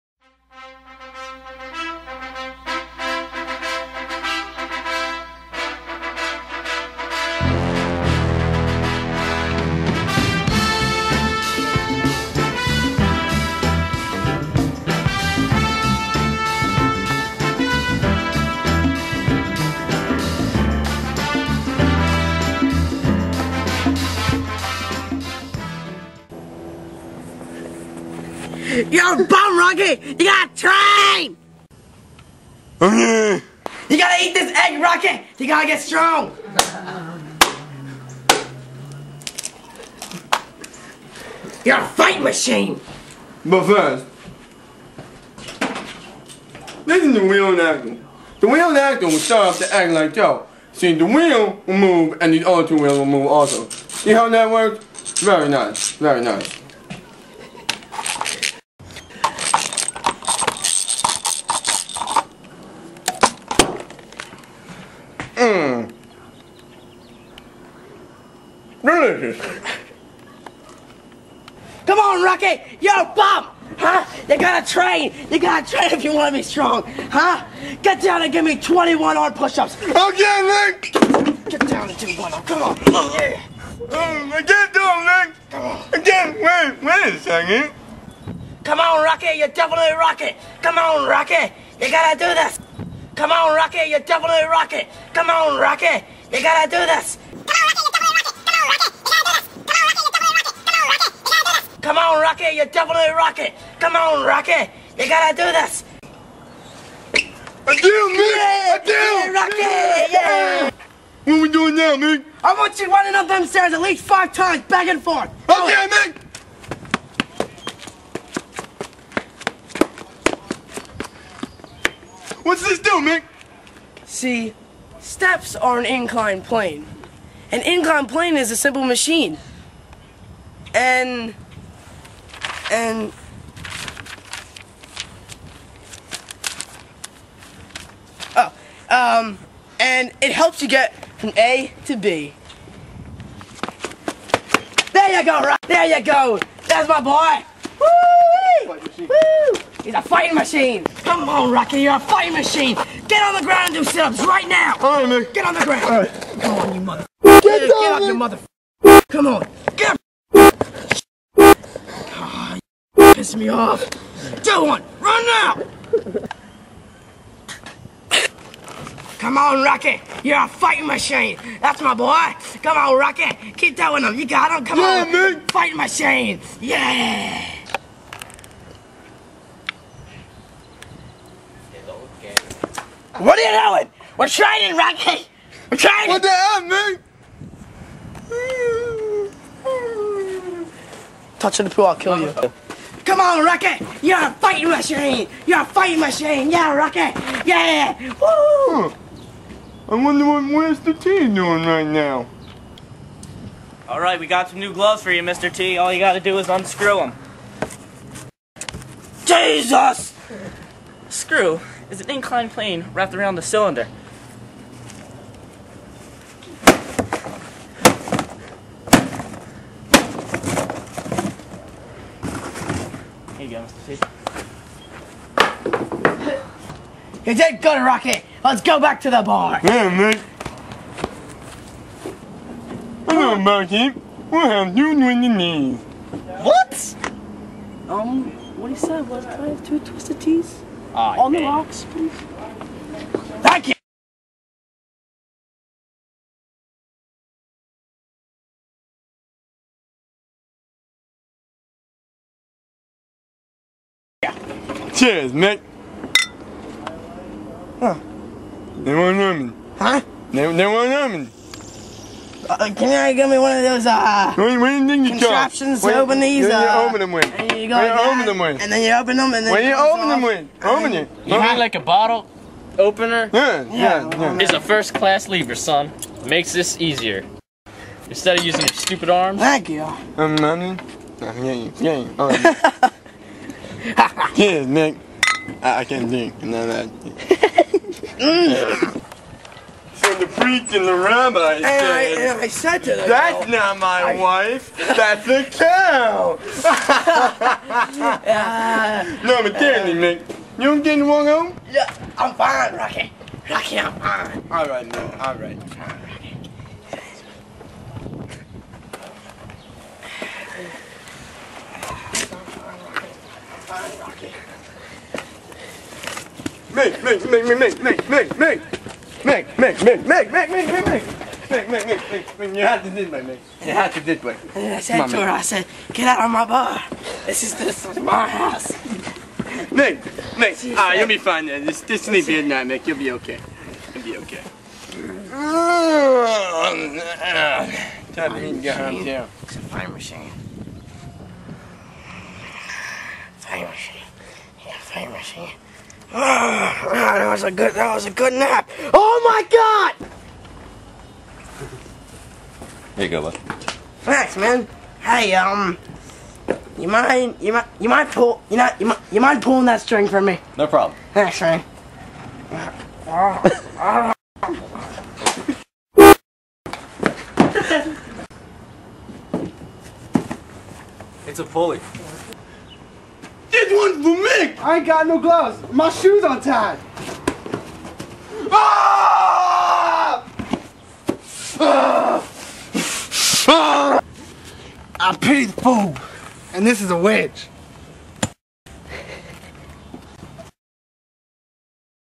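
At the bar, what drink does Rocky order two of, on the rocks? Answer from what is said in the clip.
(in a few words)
Twisted Tees.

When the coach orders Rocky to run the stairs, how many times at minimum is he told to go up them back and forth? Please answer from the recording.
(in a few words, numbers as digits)
5.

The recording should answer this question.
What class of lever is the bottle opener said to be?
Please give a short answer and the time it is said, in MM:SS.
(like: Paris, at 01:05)
First class, at 04:34.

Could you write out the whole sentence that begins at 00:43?
But first, listen to wheel acting.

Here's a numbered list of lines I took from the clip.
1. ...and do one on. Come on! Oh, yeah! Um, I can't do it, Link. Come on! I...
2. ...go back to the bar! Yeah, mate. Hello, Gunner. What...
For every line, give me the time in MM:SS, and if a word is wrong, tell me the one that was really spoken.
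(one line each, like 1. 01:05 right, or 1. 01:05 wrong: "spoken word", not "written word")
1. 01:21 right
2. 03:48 wrong: "Rocket", not "Gunner".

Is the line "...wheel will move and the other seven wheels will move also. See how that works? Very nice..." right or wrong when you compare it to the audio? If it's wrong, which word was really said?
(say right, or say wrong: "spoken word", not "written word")
wrong: "two", not "seven".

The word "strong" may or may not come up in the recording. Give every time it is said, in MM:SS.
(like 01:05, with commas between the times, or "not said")
00:35, 01:16.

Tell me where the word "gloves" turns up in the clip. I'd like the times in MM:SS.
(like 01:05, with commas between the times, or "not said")
03:24, 06:15.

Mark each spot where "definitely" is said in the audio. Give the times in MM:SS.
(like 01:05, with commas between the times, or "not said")
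01:29, 01:34, 01:42.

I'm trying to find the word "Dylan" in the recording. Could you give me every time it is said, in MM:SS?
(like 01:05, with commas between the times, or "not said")
02:44.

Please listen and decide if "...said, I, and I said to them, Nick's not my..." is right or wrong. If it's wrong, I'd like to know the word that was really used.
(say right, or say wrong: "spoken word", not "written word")
wrong: "That", not "Nick".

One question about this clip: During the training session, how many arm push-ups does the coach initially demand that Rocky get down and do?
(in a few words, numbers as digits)
21.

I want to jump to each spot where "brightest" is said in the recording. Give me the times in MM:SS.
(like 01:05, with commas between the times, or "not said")
not said.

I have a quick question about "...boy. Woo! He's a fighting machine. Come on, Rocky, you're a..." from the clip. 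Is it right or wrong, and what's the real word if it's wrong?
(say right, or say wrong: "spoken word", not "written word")
right.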